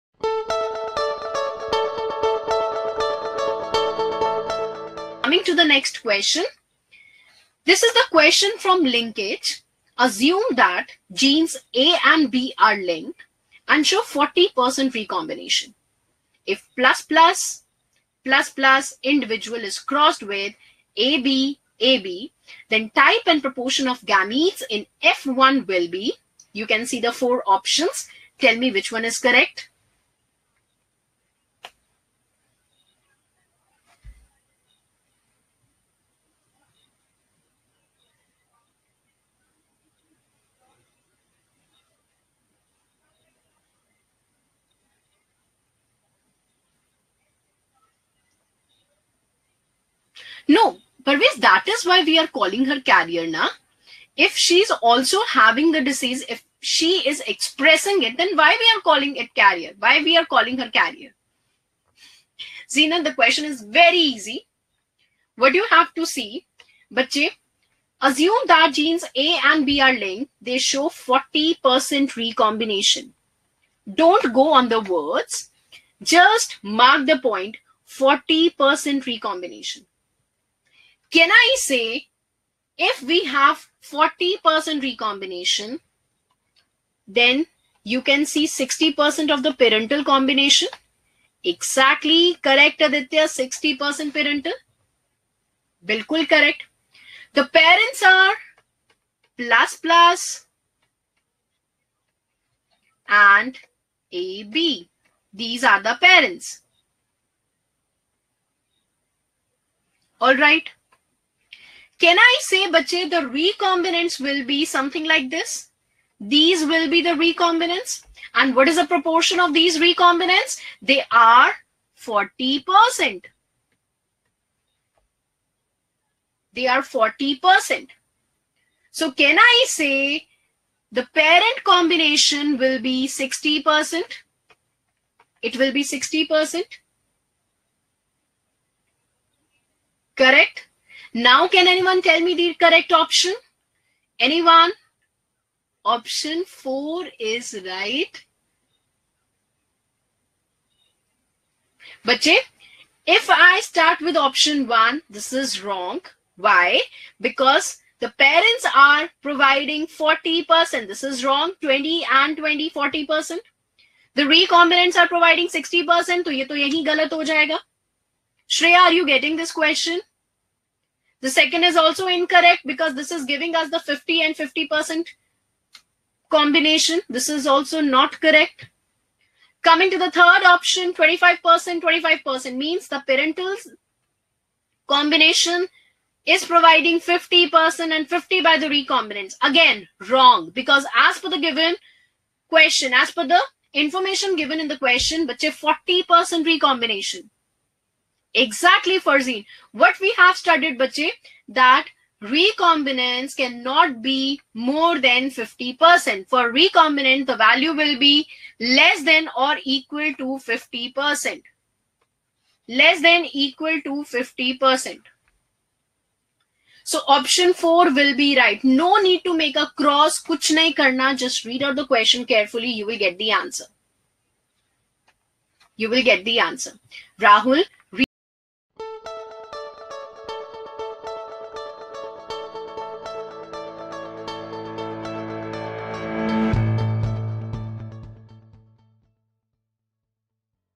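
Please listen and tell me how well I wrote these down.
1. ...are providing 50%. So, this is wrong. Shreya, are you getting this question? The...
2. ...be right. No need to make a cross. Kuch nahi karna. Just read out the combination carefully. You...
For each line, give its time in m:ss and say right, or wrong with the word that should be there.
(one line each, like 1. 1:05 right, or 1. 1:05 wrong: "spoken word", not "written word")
1. 2:44 wrong: "60", not "50"
2. 3:38 wrong: "question", not "combination".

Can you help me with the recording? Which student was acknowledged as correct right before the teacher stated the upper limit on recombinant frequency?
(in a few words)
Farzin.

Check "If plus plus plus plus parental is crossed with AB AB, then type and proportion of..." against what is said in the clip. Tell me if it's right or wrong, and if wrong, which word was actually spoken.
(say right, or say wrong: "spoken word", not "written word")
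wrong: "individual", not "parental".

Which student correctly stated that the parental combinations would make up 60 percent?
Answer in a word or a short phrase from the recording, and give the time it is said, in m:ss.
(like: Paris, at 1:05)
Aditya, at 1:32.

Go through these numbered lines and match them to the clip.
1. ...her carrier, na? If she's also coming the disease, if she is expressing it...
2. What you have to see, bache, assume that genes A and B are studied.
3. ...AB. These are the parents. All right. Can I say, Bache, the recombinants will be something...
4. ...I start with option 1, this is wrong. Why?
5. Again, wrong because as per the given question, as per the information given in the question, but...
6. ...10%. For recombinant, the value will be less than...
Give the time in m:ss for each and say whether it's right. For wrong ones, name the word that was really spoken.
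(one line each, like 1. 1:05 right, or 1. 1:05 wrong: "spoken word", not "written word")
1. 0:52 wrong: "having", not "coming"
2. 1:05 wrong: "linked", not "studied"
3. 1:44 right
4. 2:33 right
5. 3:09 right
6. 3:25 wrong: "50", not "10".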